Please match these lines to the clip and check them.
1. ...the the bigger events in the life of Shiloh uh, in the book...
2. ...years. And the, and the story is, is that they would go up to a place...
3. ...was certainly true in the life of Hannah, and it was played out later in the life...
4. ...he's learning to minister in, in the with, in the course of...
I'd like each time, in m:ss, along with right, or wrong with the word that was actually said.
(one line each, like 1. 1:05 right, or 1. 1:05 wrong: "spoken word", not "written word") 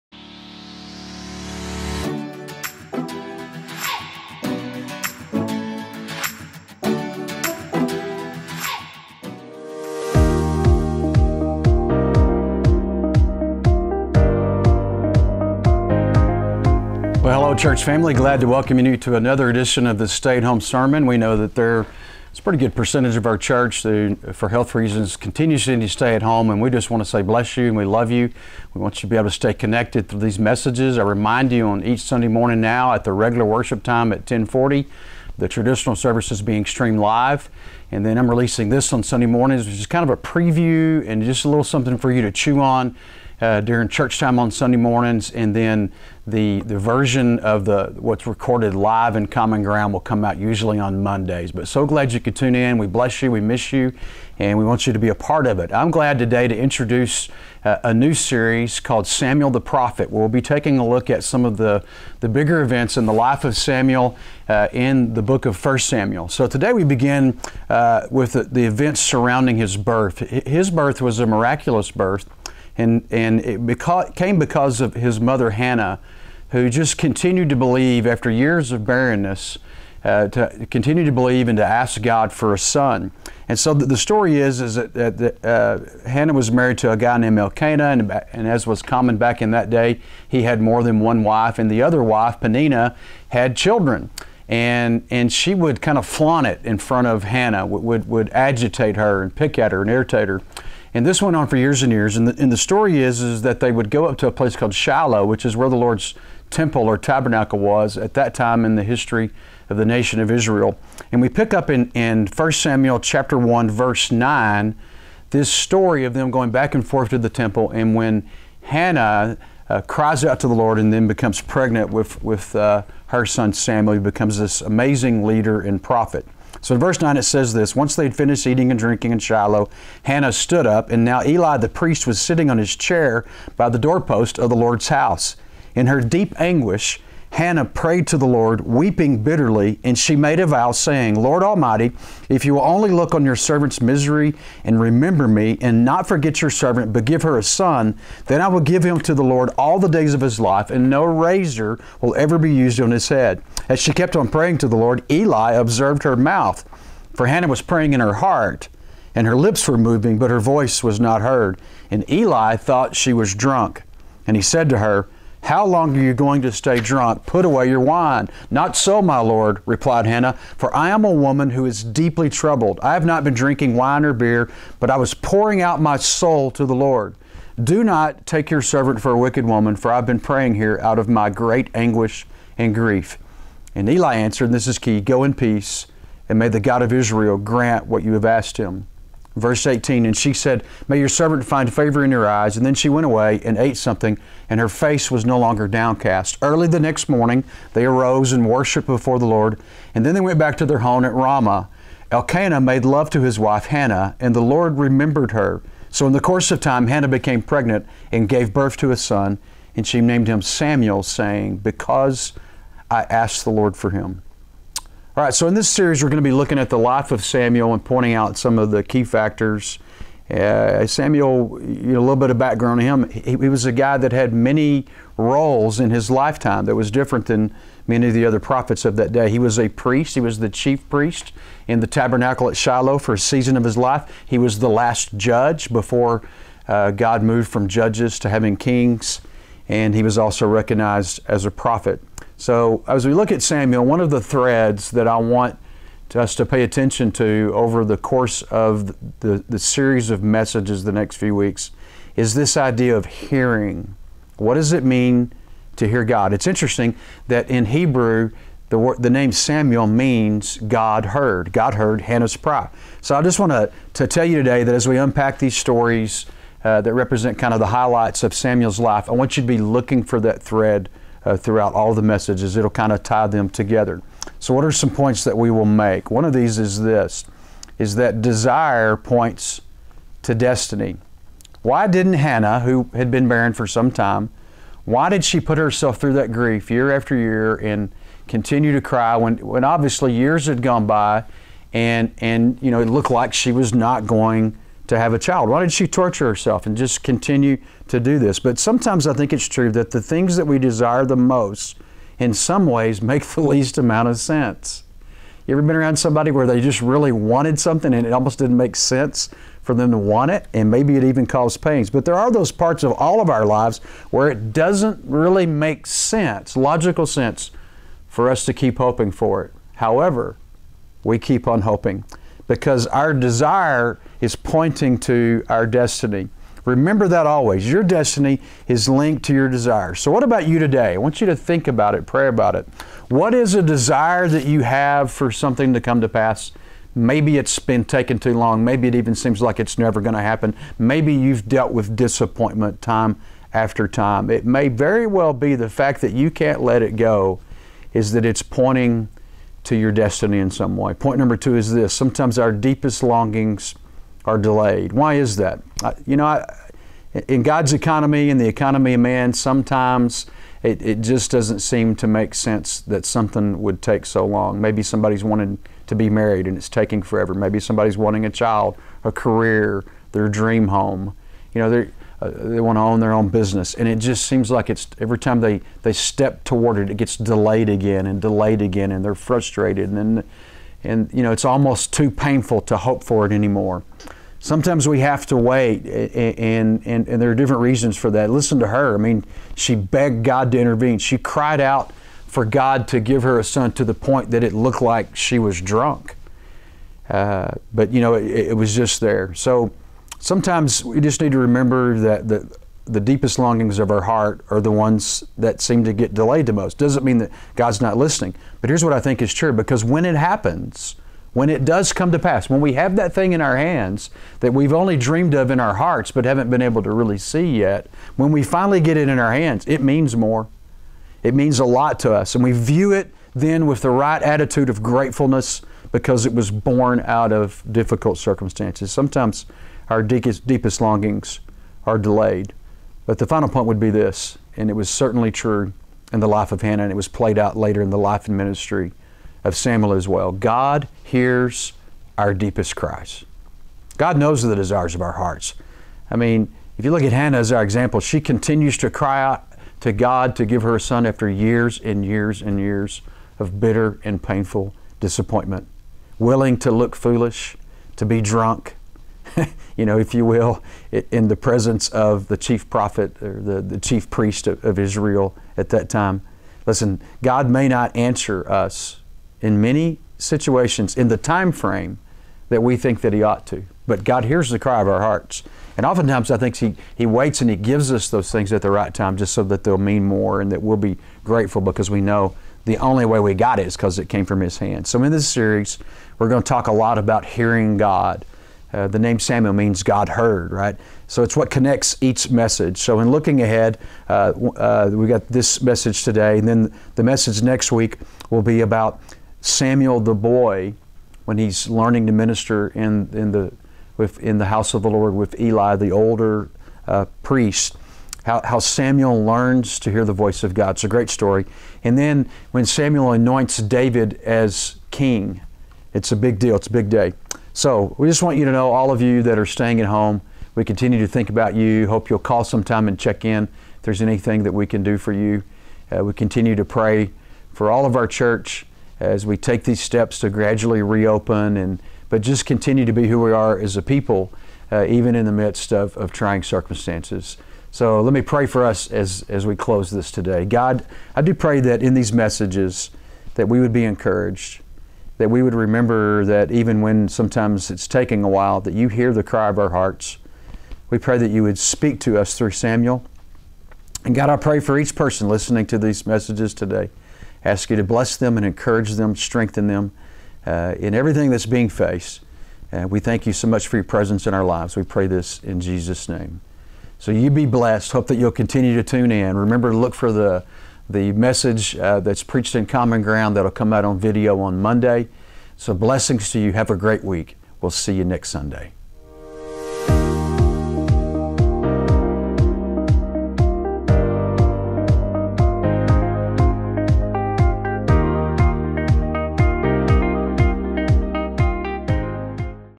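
1. 1:01 wrong: "Samuel", not "Shiloh"
2. 1:41 right
3. 7:14 right
4. 8:21 wrong: "house", not "course".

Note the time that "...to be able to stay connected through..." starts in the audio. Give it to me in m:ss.
0:29.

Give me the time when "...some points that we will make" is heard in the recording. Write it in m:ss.
4:34.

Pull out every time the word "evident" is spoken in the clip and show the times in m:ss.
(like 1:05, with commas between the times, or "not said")
not said.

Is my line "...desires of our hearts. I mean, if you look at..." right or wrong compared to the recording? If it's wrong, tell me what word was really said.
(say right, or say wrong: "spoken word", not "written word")
right.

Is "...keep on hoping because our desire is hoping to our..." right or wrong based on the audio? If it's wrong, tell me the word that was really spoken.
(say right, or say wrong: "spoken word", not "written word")
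wrong: "pointing", not "hoping".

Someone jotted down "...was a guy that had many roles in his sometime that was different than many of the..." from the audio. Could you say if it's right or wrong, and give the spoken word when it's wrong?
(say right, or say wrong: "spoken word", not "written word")
wrong: "lifetime", not "sometime".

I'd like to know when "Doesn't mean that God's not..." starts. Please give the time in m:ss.
6:46.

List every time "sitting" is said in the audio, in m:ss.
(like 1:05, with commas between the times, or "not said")
2:12.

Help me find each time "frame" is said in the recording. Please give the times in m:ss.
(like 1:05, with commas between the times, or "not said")
7:51.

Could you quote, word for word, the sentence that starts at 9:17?
ask you to bless them and encourage them, strengthen them uh, in everything that's being faced.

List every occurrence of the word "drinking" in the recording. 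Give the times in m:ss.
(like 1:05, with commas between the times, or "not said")
2:08, 2:53.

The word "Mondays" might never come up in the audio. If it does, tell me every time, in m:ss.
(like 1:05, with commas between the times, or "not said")
0:51, 9:34.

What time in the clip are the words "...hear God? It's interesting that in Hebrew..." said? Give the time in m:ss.
4:15.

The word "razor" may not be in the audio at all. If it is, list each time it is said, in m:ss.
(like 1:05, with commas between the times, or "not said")
2:31.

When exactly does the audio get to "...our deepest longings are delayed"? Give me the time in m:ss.
5:52.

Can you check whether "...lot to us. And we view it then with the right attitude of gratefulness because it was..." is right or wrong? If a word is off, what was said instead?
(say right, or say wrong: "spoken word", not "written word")
right.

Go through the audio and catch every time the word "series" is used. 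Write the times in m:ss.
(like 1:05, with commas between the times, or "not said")
0:58, 3:35, 4:09, 8:05.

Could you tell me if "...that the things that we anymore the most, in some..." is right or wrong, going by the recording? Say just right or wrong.
wrong.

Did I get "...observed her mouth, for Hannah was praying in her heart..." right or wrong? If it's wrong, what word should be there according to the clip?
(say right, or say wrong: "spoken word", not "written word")
right.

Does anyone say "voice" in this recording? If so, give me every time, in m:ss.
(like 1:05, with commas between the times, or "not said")
2:40, 8:30.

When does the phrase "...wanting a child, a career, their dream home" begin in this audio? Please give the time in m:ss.
6:07.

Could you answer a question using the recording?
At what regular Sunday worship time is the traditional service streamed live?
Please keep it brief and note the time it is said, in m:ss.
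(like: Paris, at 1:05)
10:40, at 0:34.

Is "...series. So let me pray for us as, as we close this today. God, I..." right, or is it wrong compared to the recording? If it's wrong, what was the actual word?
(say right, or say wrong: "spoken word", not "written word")
wrong: "circumstances", not "series".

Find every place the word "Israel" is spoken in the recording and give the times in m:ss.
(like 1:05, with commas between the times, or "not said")
1:50, 3:06, 7:44.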